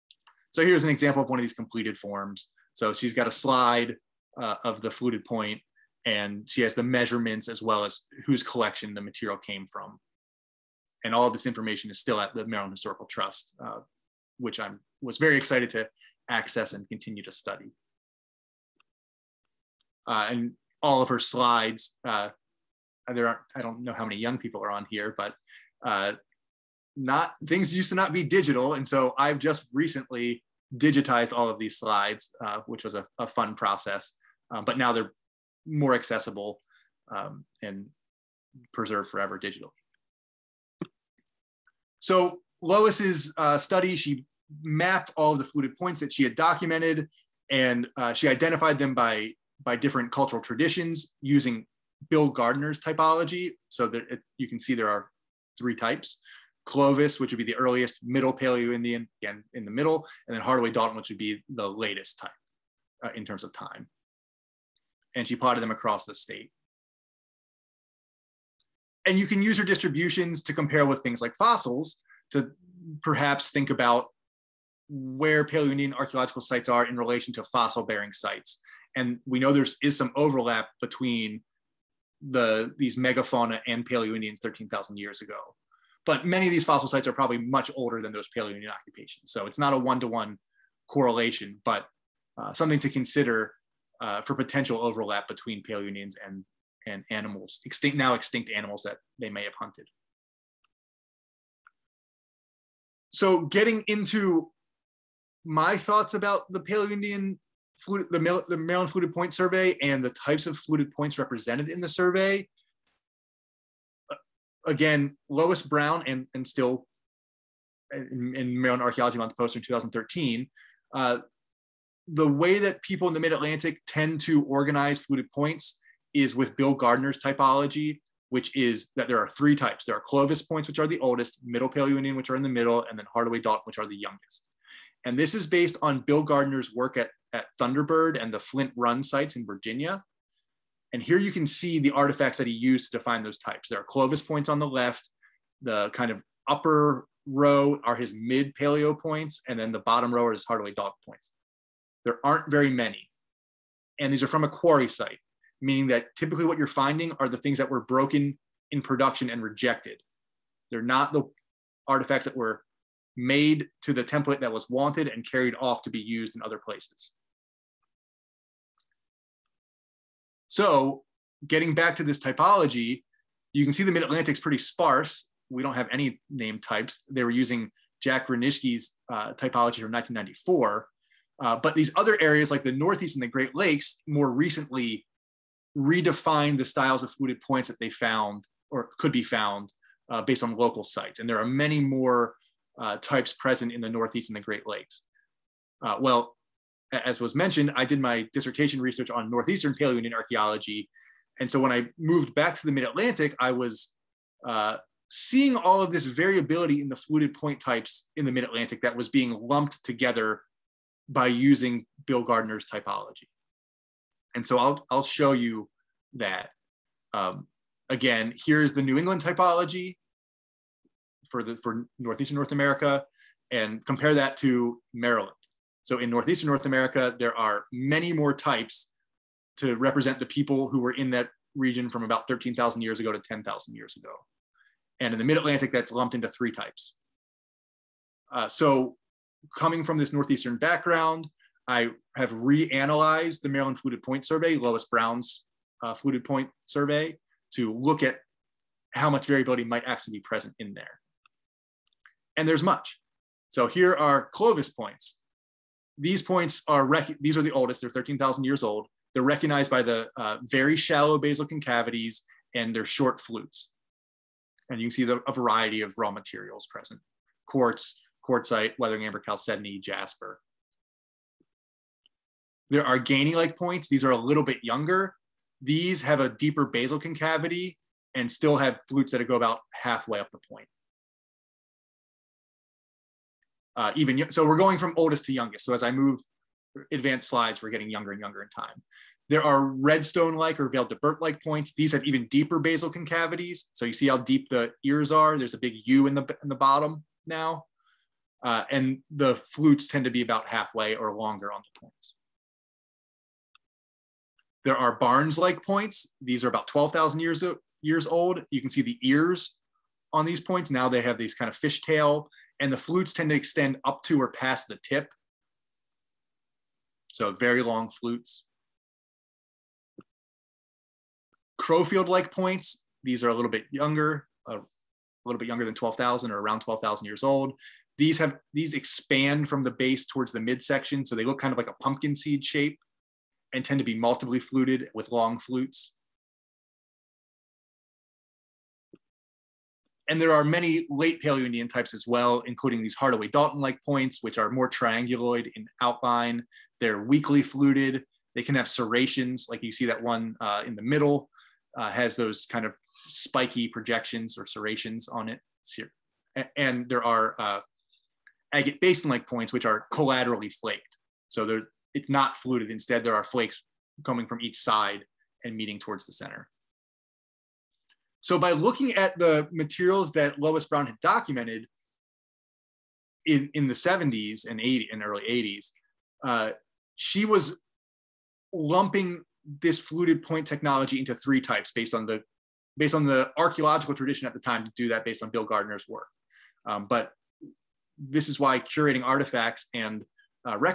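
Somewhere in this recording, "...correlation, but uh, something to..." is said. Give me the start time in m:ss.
1:30.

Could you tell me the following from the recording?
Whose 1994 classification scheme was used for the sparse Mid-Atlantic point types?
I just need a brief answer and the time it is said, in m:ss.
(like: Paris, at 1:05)
Jack Renishke, at 2:58.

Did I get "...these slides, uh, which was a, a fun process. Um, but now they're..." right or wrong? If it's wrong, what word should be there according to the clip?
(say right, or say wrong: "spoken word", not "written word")
right.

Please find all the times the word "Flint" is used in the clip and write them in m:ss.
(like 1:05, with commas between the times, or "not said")
2:18.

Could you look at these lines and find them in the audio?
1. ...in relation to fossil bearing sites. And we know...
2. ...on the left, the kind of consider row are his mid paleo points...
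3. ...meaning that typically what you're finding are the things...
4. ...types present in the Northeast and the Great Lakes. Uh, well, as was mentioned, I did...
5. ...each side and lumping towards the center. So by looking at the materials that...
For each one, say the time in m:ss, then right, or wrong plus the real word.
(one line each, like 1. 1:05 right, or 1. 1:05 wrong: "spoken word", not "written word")
1. 1:16 right
2. 2:24 wrong: "upper", not "consider"
3. 2:35 right
4. 3:12 right
5. 6:04 wrong: "meeting", not "lumping".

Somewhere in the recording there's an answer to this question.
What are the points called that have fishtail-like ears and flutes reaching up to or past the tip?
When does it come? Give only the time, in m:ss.
5:04.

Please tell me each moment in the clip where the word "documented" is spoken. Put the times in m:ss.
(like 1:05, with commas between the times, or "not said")
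0:46, 6:11.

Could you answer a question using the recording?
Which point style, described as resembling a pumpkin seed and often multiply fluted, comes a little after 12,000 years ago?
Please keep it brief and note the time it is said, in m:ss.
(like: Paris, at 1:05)
Crowfield-like, at 5:21.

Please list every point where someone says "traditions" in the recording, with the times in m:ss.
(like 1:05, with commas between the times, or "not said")
0:50, 6:23.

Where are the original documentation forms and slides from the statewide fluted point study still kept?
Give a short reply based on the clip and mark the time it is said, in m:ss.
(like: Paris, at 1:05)
Maryland Historical Trust, at 0:12.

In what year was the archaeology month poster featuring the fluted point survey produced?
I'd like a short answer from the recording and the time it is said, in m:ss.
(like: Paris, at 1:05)
2013, at 1:59.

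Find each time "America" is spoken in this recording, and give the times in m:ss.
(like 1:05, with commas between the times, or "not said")
3:42, 3:46.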